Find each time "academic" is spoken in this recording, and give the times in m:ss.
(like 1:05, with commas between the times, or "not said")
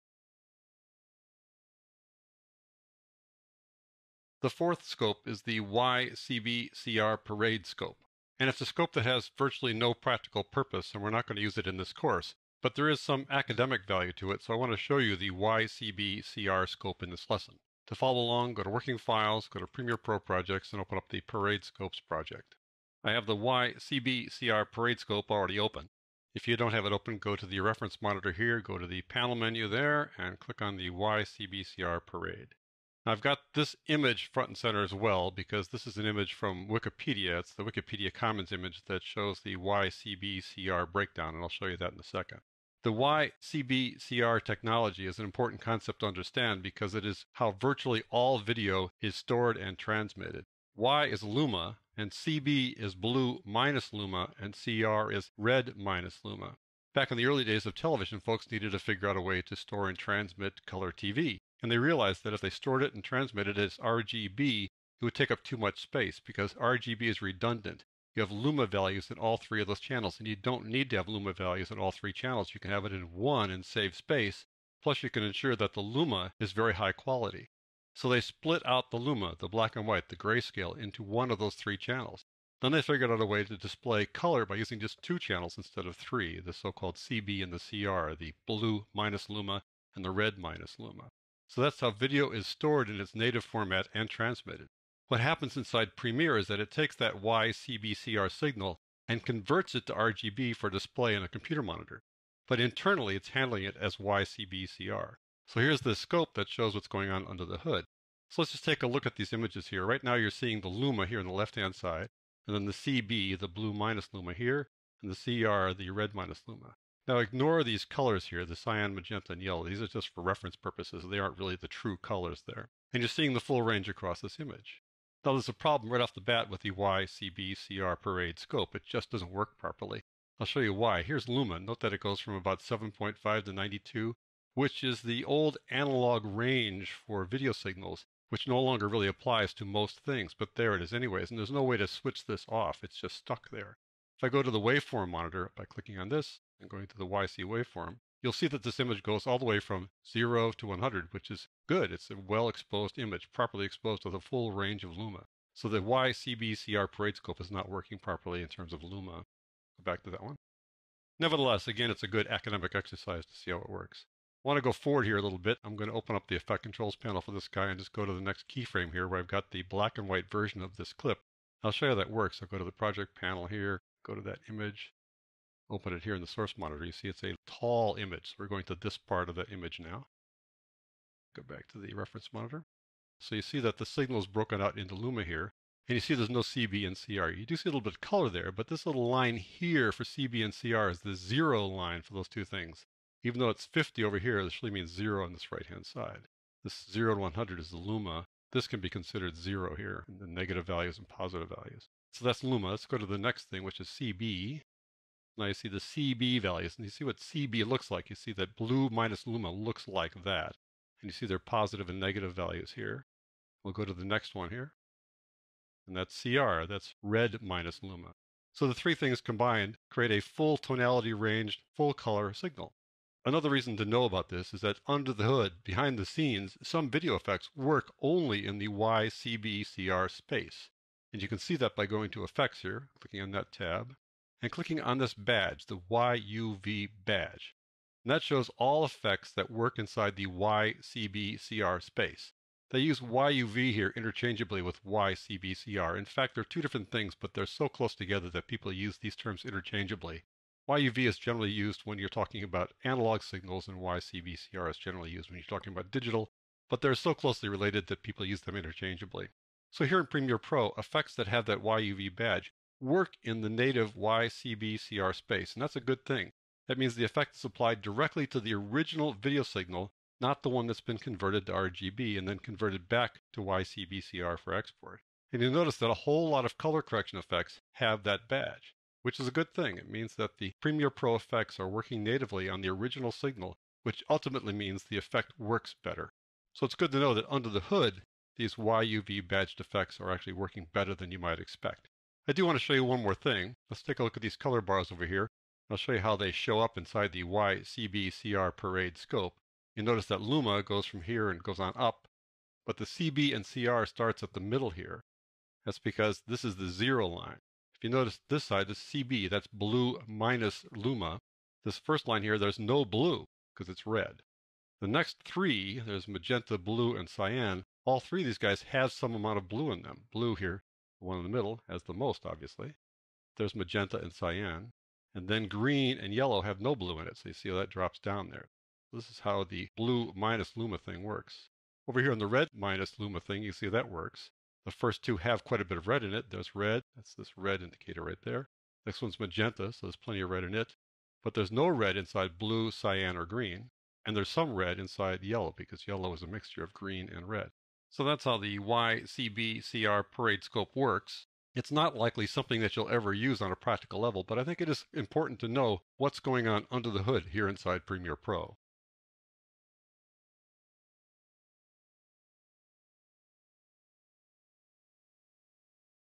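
0:13, 2:42.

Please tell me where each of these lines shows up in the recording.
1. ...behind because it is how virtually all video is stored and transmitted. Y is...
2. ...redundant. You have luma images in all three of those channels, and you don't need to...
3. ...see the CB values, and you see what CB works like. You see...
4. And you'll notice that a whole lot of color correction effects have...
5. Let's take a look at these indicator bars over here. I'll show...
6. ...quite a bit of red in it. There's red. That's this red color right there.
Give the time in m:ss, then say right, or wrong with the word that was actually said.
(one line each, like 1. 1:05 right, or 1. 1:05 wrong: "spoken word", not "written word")
1. 0:46 wrong: "understand", not "behind"
2. 1:07 wrong: "values", not "images"
3. 3:25 wrong: "looks", not "works"
4. 4:35 right
5. 4:53 wrong: "color", not "indicator"
6. 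5:35 wrong: "indicator", not "color".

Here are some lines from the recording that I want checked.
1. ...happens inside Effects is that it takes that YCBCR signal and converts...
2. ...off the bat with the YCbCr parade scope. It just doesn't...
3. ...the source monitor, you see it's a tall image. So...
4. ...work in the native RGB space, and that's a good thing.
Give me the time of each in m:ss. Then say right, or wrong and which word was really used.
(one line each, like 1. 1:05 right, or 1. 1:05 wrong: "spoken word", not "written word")
1. 1:35 wrong: "Premiere", not "Effects"
2. 2:05 right
3. 2:56 right
4. 4:22 wrong: "YCBCR", not "RGB".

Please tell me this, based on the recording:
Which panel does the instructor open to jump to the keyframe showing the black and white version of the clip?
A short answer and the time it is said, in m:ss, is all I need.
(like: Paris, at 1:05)
Effect controls panel, at 2:46.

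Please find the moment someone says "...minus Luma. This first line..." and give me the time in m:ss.
5:10.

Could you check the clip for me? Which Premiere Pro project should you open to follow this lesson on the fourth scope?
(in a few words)
Parade Scopes.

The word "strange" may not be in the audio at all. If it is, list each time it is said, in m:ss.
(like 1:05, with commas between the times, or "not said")
not said.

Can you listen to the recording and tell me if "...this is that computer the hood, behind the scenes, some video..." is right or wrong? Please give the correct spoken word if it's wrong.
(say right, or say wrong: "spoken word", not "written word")
wrong: "under", not "computer".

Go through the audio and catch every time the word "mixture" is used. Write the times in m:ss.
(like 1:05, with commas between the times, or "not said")
5:46.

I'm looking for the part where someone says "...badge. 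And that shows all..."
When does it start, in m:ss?
3:57.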